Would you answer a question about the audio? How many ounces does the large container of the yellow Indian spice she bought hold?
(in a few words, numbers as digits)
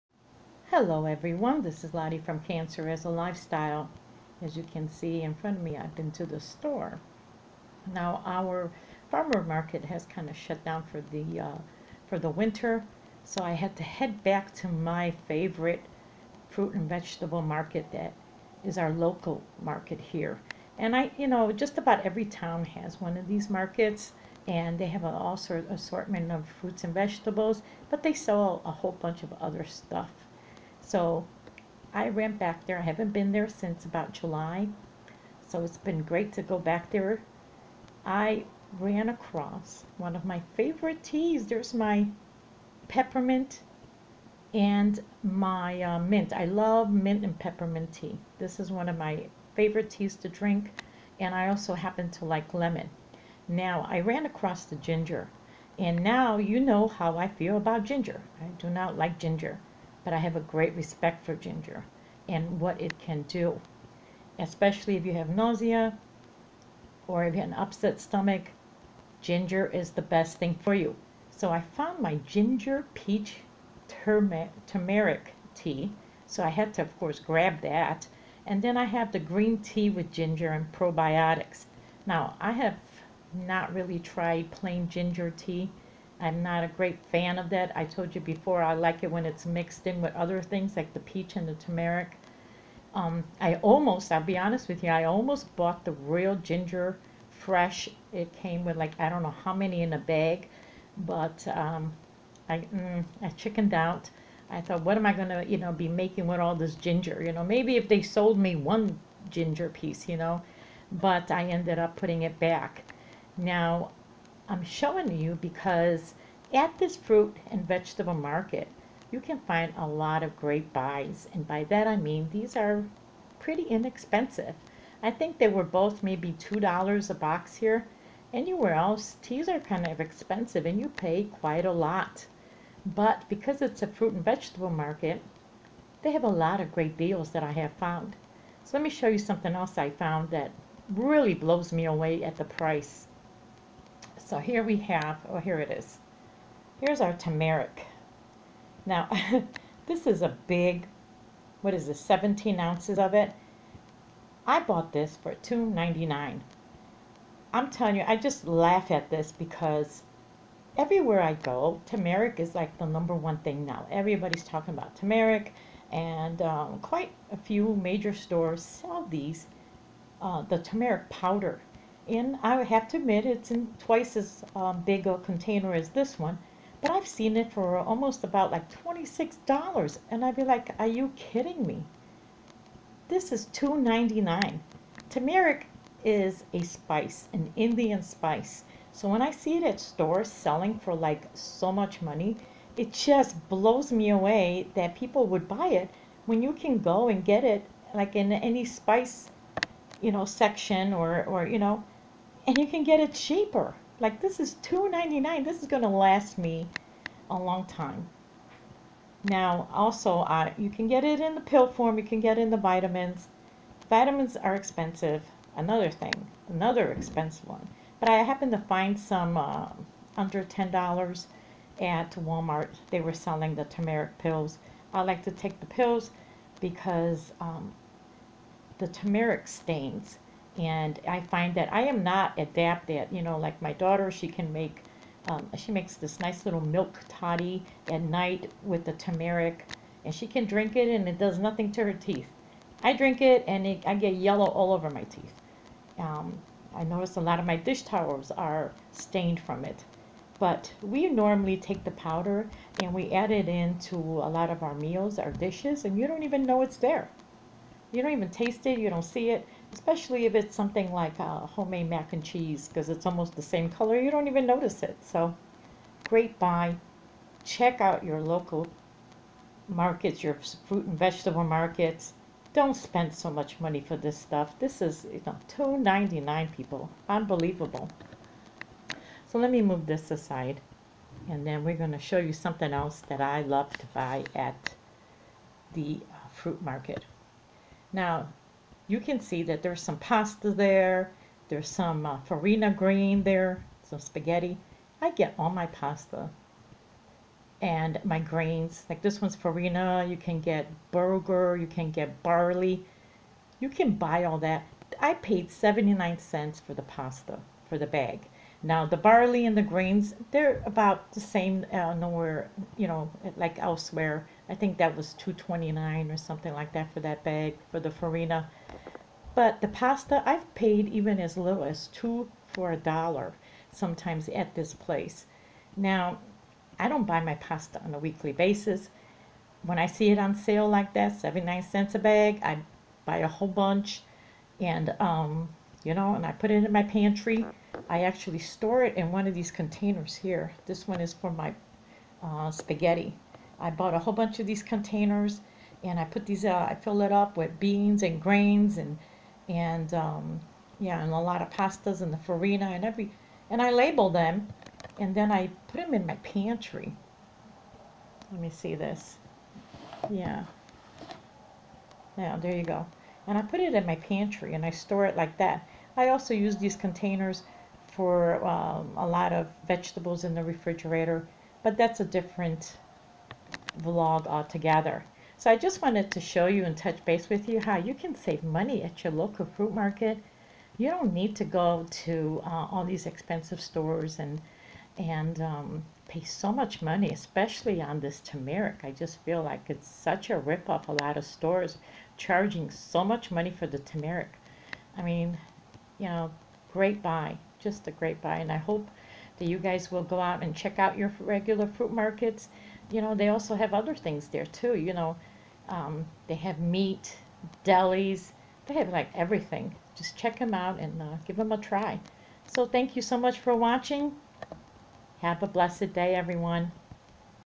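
17.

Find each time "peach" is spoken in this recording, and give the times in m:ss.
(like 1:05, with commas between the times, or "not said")
1:12, 1:30.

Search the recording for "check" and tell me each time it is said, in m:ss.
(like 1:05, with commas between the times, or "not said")
4:27, 6:40, 6:50.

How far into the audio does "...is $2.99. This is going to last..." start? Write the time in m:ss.
3:24.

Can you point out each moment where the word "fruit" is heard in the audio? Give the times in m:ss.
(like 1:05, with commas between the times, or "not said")
0:16, 0:26, 1:56, 2:13, 4:30, 4:46, 6:19, 6:41.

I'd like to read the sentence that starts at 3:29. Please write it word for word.
Now, also, uh, you can get it in the pill form.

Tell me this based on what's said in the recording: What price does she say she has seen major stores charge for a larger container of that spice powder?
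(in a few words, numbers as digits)
$26.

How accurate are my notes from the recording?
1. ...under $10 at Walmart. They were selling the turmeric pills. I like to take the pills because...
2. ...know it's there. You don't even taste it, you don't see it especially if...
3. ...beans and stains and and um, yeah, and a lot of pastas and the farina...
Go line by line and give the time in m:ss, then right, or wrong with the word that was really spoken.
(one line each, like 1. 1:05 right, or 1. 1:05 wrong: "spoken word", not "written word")
1. 3:40 right
2. 4:16 right
3. 5:47 wrong: "grains", not "stains".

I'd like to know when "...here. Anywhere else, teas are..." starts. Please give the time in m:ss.
2:07.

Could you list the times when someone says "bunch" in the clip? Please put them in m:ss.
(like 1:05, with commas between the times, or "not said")
0:28, 5:33, 5:44.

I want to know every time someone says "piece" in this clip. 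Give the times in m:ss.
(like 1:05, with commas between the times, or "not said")
1:49.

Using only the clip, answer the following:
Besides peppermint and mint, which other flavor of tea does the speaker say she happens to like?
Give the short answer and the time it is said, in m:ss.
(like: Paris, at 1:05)
Lemon, at 0:52.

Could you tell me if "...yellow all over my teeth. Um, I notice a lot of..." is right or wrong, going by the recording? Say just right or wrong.
right.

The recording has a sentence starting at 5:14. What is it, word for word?
I think that was 229 or something like that for that bag for the farina.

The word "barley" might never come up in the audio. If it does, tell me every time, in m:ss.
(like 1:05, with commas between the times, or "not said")
5:02, 5:08.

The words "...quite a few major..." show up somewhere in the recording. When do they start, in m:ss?
2:46.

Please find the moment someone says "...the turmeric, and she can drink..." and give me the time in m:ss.
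3:58.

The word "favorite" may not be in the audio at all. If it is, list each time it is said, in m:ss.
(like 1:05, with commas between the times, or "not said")
0:15, 0:40, 0:49.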